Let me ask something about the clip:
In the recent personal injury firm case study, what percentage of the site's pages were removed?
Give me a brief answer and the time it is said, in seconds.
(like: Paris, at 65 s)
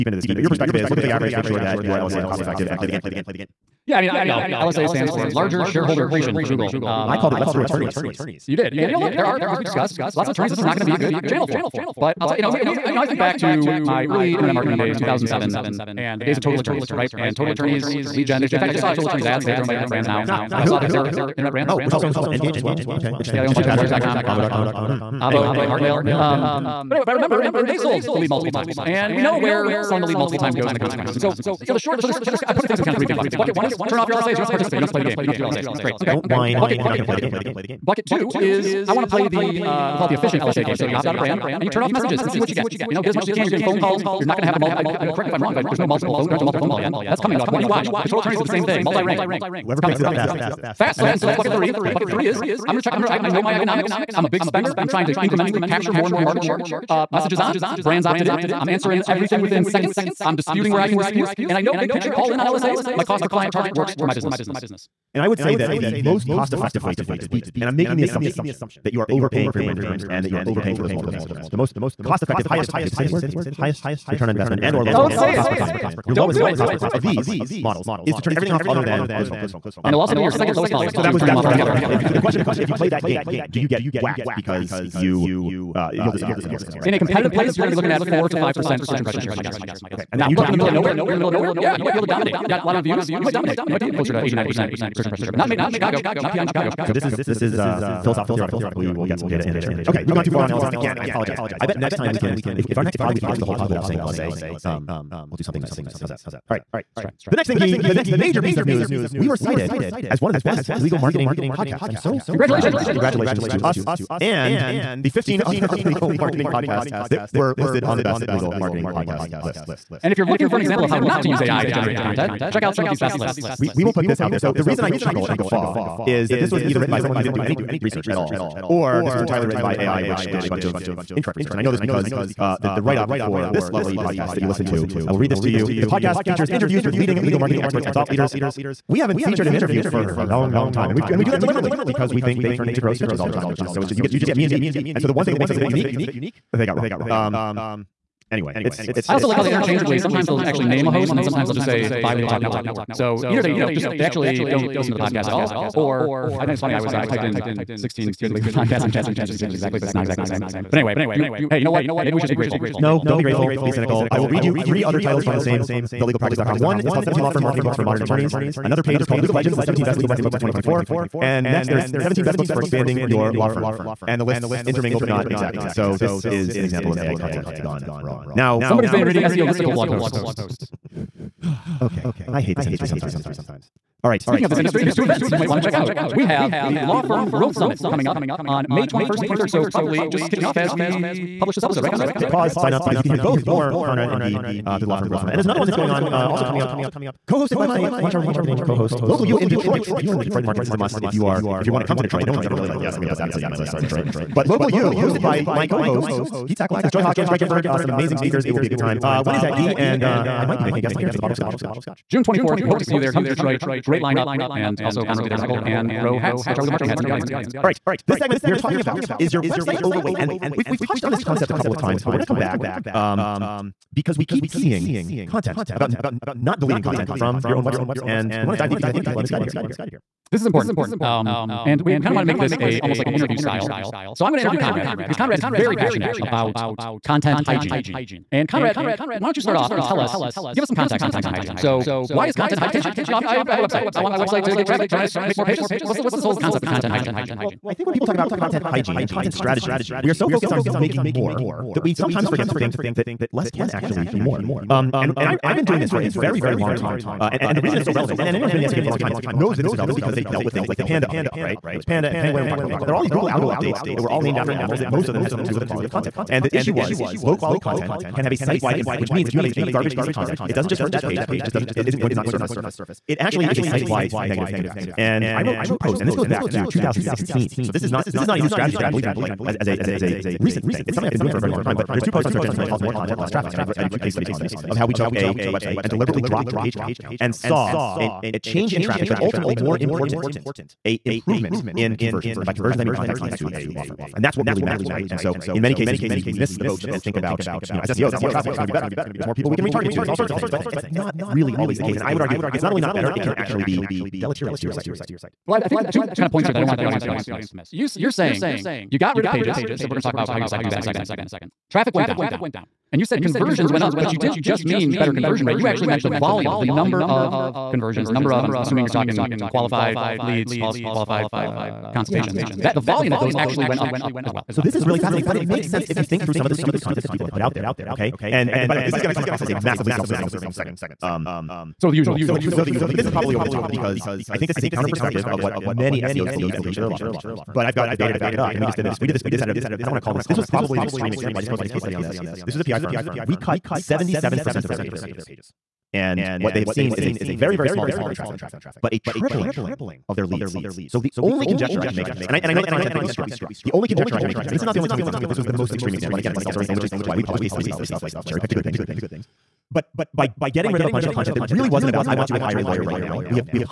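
77%, at 343 s.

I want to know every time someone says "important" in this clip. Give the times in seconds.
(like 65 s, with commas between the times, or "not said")
230 s, 289 s.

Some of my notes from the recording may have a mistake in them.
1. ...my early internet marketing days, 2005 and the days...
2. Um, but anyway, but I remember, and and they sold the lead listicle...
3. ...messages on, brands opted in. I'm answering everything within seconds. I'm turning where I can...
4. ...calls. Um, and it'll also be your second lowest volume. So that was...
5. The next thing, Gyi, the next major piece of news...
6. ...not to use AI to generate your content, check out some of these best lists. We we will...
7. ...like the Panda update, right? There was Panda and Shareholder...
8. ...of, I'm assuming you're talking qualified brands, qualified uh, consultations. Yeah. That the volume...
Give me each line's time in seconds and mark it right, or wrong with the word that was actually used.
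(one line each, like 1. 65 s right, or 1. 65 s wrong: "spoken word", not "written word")
1. 13 s wrong: "2007", not "2005"
2. 26 s wrong: "multiple", not "listicle"
3. 57 s wrong: "disputing", not "turning"
4. 79 s right
5. 107 s right
6. 120 s right
7. 260 s wrong: "Penguin", not "Shareholder"
8. 318 s wrong: "leads", not "brands".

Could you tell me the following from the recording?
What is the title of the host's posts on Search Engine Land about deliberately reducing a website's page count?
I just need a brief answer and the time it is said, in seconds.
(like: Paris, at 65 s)
More Content, Less Traffic, at 282 s.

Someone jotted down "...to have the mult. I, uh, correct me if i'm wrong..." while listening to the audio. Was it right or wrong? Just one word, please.
right.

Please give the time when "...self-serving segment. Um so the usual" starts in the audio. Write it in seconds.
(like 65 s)
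329 s.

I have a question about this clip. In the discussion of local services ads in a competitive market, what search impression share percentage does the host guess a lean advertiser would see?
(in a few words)
4 to 5 percent.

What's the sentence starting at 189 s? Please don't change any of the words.
So, probably just kicking off as we publish this episode, right, Conrad?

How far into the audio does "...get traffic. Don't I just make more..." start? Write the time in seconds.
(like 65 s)
244 s.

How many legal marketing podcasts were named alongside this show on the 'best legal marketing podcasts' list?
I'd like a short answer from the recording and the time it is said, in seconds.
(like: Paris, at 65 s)
15, at 115 s.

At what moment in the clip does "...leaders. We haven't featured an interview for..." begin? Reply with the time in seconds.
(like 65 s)
138 s.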